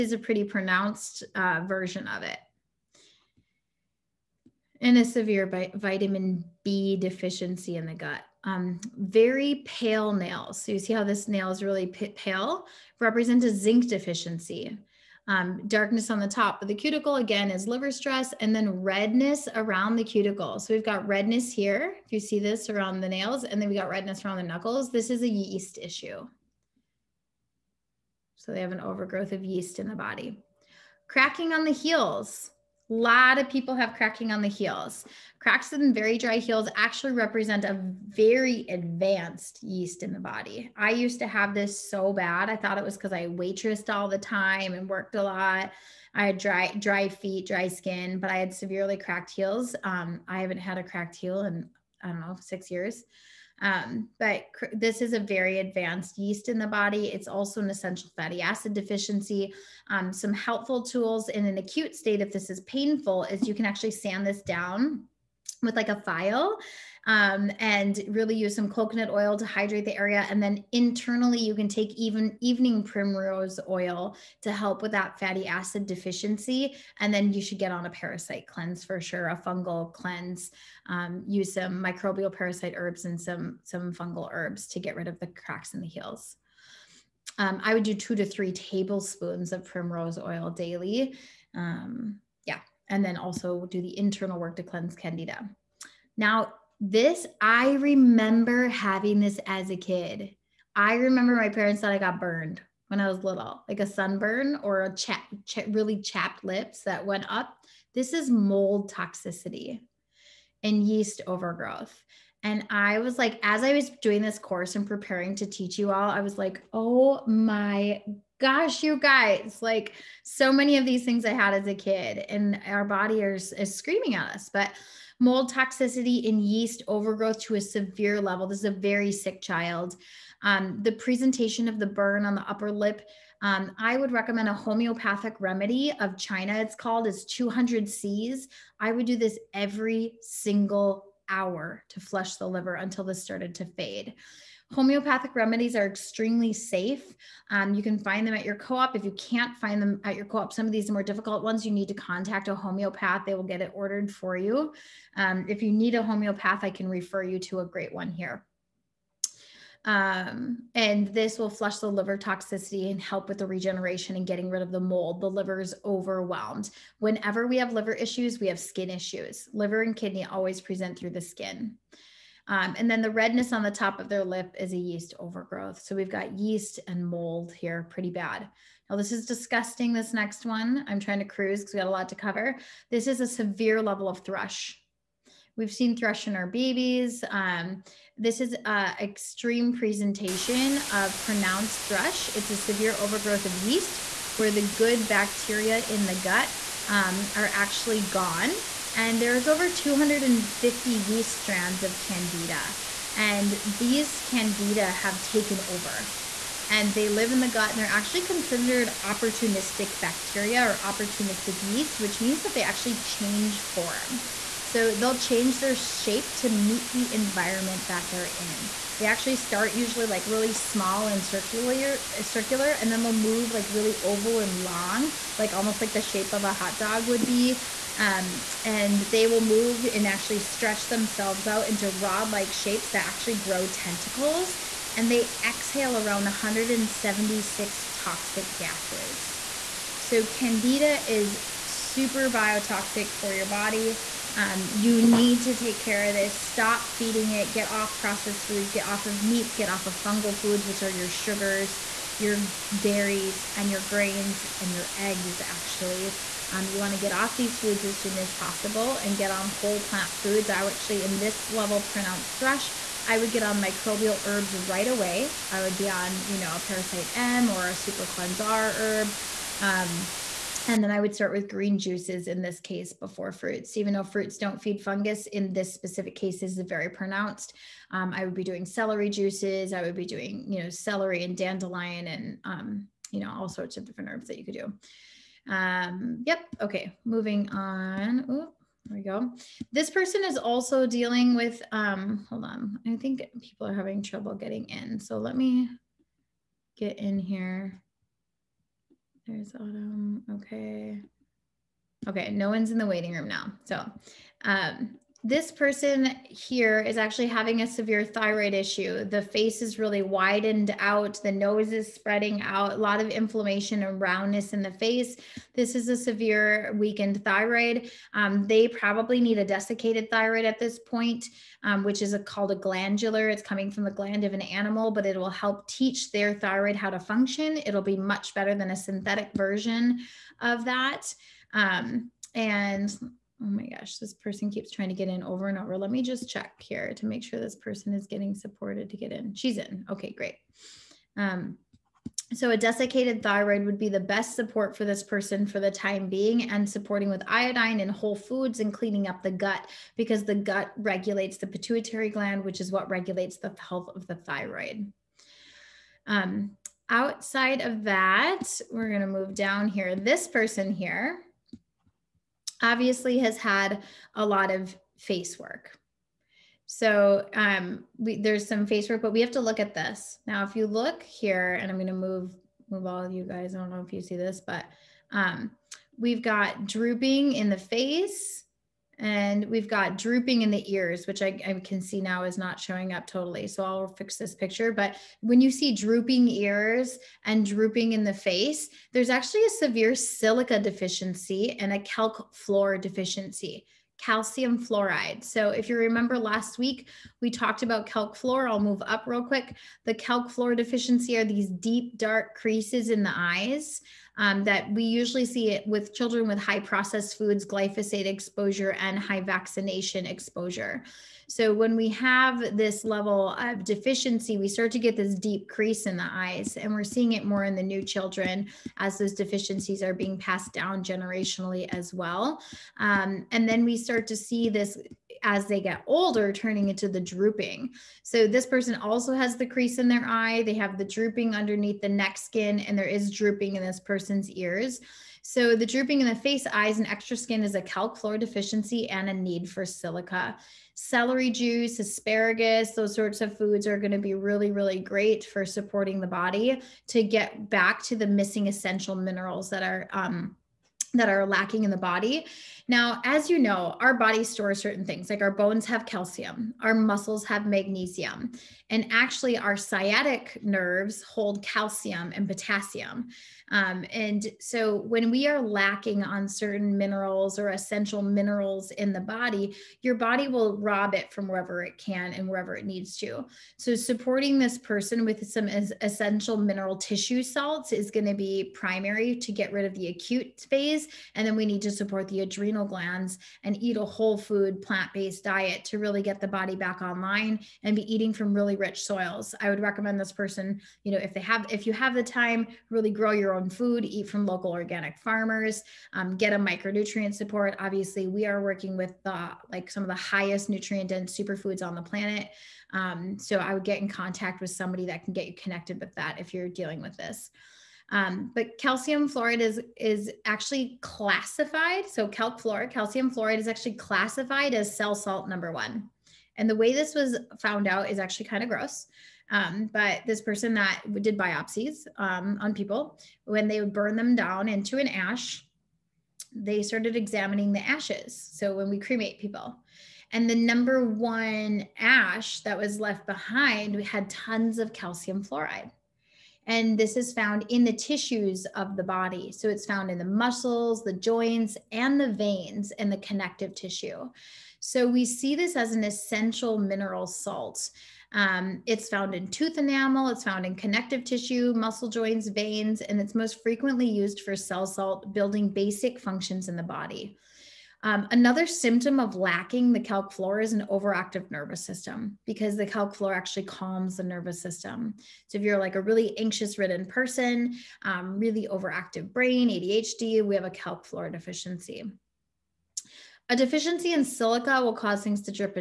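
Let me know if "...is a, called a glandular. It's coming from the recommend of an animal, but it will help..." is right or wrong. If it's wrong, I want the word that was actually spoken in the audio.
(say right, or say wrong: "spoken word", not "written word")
wrong: "gland", not "recommend".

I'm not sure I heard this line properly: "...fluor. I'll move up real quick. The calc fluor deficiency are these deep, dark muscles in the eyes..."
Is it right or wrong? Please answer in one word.
wrong.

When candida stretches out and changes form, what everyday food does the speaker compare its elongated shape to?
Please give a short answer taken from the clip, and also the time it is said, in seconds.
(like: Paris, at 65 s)
A hot dog, at 226 s.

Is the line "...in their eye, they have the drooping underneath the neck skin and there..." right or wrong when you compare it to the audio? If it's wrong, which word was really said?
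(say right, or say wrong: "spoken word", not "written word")
right.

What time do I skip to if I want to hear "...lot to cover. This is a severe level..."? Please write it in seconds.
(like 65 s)
181 s.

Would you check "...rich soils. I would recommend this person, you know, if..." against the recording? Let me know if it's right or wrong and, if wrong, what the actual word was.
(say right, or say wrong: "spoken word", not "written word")
right.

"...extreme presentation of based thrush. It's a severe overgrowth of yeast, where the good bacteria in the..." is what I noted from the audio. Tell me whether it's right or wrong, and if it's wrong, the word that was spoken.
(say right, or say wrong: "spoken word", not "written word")
wrong: "pronounced", not "based".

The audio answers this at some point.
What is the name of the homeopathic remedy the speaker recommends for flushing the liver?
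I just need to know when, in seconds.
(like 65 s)
136 s.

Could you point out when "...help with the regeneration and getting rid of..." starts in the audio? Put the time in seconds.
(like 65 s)
163 s.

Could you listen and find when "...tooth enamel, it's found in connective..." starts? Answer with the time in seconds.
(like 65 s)
549 s.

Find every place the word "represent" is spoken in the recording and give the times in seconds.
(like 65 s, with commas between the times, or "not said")
13 s, 37 s.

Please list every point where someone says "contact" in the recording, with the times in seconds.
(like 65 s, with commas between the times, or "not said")
151 s, 503 s.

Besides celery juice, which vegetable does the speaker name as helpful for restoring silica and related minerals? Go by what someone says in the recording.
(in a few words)
Asparagus.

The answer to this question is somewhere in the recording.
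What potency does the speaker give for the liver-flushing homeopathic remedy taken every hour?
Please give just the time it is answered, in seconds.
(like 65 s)
137 s.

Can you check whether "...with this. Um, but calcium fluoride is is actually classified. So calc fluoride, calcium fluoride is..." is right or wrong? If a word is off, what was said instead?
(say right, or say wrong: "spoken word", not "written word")
right.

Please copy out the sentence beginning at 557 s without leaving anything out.
Um, another symptom of lacking the calc fluor is an overactive nervous system because the calc fluor actually calms the nervous system.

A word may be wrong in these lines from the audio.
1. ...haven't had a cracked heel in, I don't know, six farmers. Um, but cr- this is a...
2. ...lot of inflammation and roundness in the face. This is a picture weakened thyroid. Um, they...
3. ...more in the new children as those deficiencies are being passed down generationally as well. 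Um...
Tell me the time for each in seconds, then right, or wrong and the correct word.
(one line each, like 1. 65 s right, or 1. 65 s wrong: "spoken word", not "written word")
1. 50 s wrong: "years", not "farmers"
2. 312 s wrong: "severe", not "picture"
3. 417 s right.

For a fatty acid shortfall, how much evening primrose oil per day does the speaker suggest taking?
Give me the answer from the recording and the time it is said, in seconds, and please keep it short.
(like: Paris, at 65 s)
2 to 3 tablespoons, at 87 s.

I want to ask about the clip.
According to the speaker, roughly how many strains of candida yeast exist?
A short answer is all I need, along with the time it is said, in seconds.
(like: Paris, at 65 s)
Over 250, at 199 s.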